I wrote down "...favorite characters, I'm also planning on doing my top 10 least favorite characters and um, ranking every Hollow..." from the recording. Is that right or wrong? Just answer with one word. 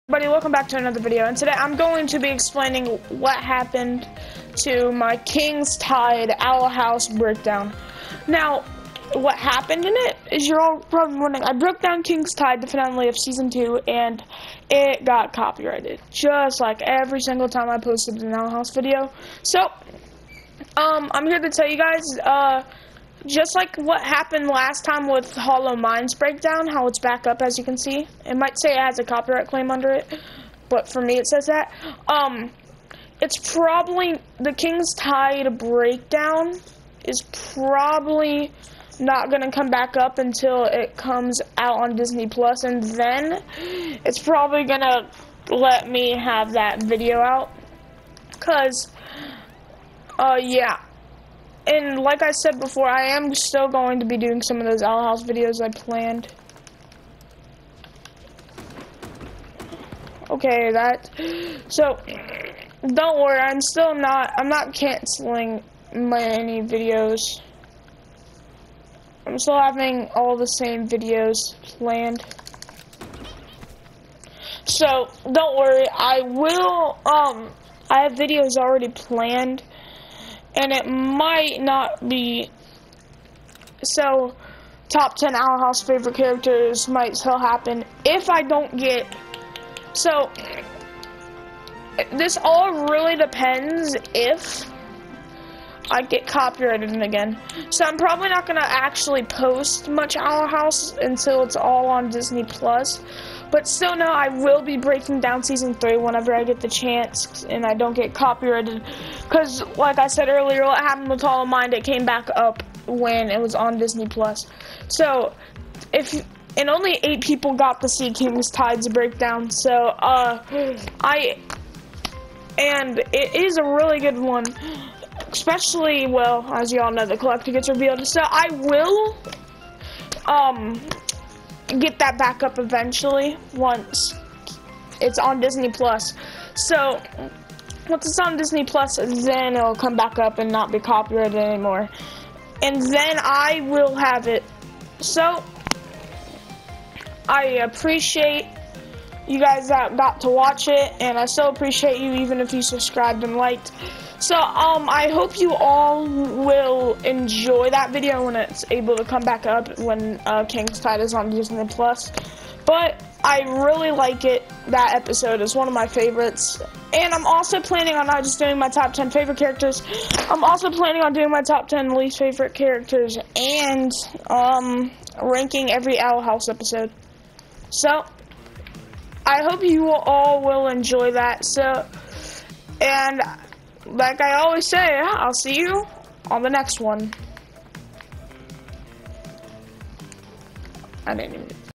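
wrong.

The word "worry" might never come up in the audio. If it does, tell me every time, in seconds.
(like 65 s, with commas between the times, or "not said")
63 s, 75 s.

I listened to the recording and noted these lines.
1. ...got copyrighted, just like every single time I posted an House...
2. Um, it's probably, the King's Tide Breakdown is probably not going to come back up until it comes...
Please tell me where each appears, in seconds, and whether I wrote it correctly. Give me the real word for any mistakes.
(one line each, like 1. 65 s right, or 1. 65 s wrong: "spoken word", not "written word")
1. 15 s wrong: "Owl", not "House"
2. 32 s right.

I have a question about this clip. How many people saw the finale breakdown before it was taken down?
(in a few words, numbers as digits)
8.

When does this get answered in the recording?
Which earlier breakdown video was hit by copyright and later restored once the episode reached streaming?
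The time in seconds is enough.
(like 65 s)
25 s.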